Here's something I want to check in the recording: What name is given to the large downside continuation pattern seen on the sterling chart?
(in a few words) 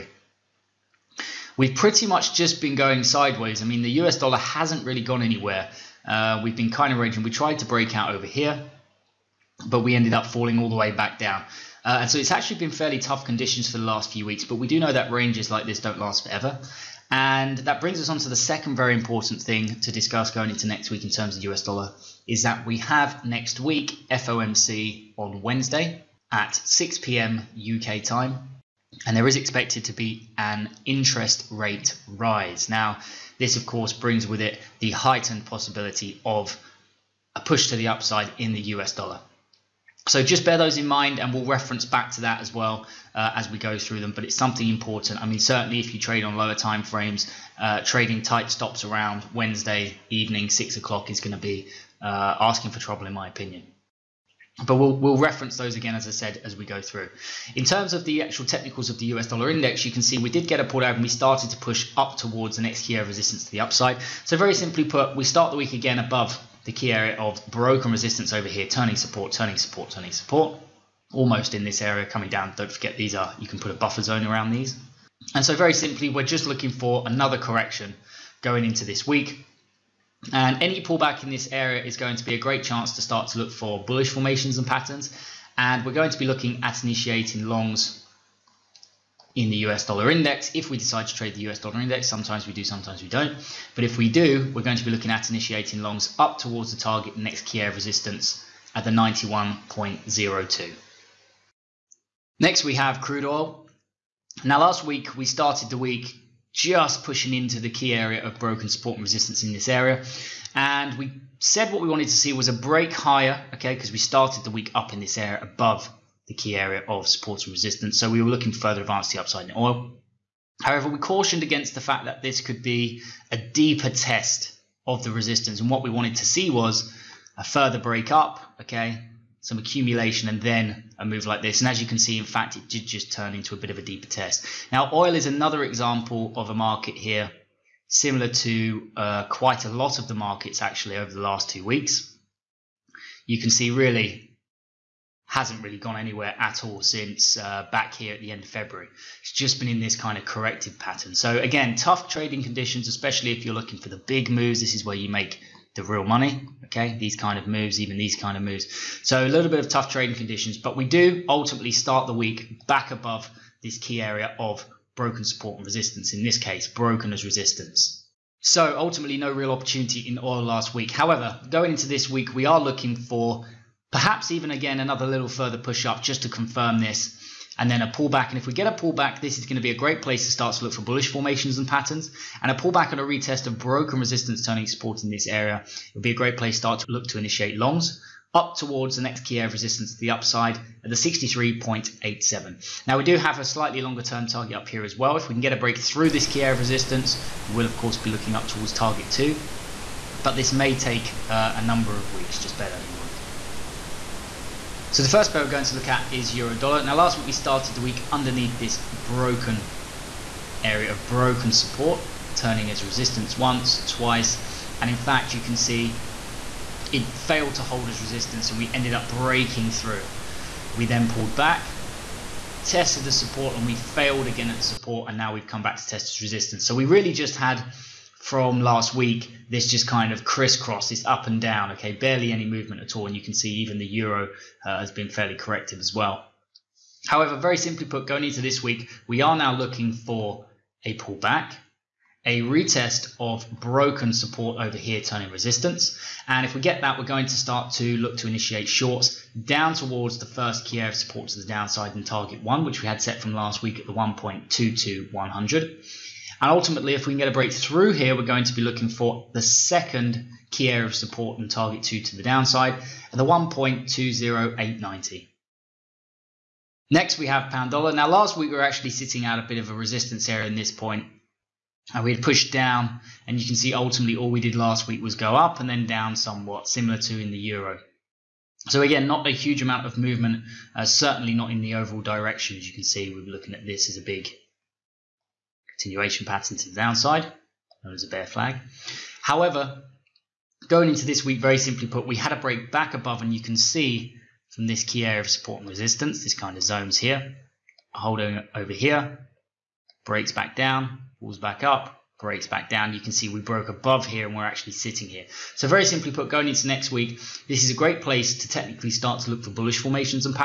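bear flag.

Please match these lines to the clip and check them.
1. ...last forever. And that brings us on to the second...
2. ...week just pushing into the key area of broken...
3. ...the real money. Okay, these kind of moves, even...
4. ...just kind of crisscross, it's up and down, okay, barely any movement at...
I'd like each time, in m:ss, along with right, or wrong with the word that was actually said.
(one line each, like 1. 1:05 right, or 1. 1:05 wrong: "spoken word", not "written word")
1. 0:15 right
2. 1:45 right
3. 2:35 right
4. 3:49 right.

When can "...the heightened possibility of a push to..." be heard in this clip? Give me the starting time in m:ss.
0:34.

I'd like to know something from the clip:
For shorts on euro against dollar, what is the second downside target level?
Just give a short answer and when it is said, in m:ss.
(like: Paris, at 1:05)
1.20890, at 4:23.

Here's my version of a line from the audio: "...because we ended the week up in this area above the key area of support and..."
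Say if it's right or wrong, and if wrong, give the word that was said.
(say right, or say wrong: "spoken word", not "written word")
wrong: "started", not "ended".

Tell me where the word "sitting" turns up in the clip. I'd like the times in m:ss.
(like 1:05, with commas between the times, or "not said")
4:28, 5:04.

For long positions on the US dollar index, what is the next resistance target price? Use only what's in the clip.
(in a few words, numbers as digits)
91.02.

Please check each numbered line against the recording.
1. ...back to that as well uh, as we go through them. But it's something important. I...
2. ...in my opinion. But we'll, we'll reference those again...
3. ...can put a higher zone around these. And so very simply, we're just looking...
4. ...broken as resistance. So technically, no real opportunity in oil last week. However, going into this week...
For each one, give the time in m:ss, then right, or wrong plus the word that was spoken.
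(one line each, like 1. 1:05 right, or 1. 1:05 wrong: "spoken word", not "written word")
1. 0:41 right
2. 0:53 right
3. 1:13 wrong: "buffer", not "higher"
4. 2:46 wrong: "ultimately", not "technically".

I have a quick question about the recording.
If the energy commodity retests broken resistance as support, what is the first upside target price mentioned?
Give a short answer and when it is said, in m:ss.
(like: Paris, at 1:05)
63.87, at 3:10.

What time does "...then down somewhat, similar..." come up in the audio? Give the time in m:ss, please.
4:35.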